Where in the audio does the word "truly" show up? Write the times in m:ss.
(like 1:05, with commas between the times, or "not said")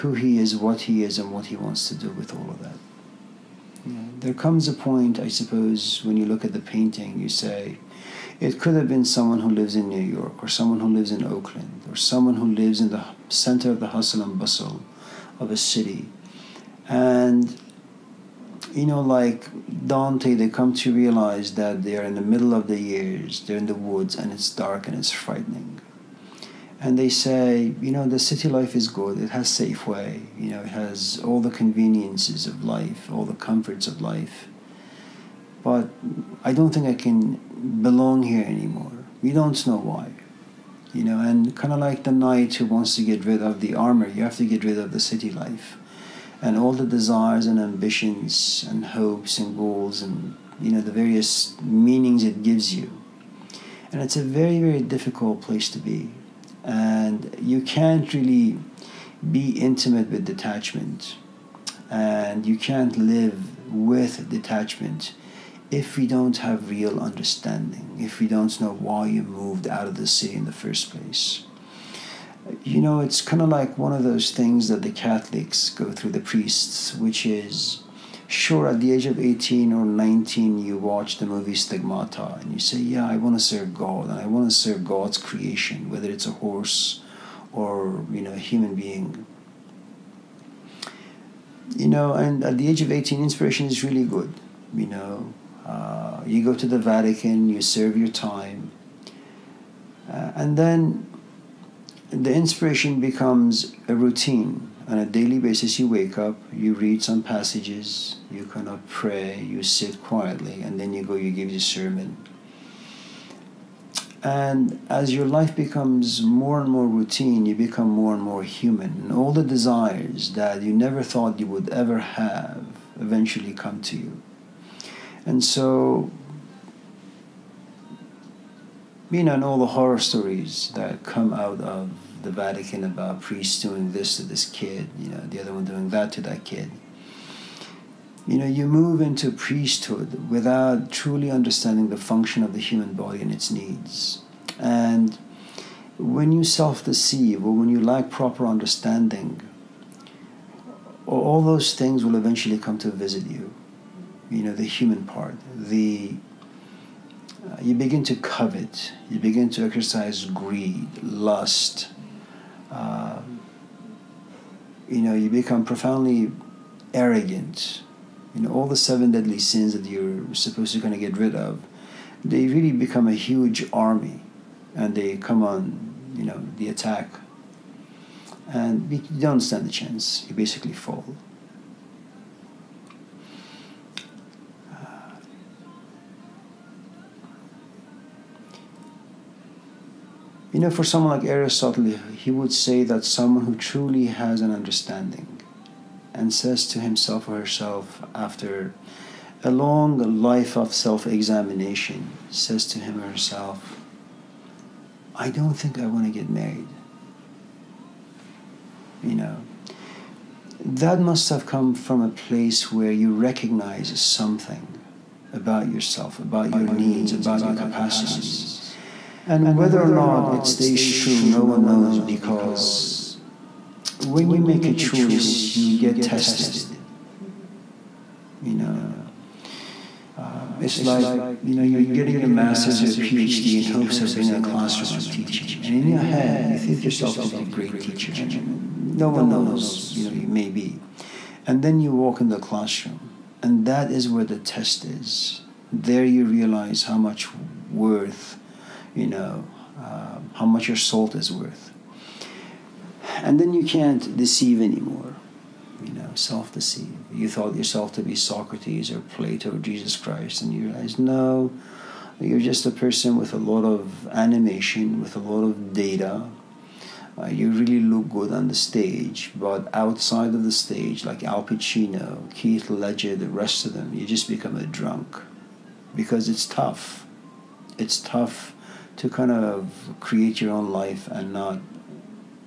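2:20, 3:13.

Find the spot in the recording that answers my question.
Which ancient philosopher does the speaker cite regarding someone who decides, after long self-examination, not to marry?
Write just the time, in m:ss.
3:11.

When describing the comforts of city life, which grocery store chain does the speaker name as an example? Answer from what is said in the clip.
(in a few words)
Safeway.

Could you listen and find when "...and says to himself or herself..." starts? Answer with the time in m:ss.
3:16.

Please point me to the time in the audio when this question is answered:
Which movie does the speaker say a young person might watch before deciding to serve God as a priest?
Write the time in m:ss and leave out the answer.
1:21.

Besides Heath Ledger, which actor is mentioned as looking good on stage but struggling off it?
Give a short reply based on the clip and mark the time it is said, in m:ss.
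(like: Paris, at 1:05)
Al Pacino, at 4:31.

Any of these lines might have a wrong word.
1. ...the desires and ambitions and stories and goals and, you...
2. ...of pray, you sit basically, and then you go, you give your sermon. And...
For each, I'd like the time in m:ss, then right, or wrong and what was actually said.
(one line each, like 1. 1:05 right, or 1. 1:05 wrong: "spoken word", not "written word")
1. 0:46 wrong: "hopes", not "stories"
2. 1:48 wrong: "quietly", not "basically".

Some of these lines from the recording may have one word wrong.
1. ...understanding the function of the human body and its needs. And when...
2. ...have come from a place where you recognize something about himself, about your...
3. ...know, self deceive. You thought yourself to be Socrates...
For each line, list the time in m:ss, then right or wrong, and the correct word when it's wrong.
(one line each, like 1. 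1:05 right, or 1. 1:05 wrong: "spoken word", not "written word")
1. 2:21 right
2. 3:31 wrong: "yourself", not "himself"
3. 4:15 right.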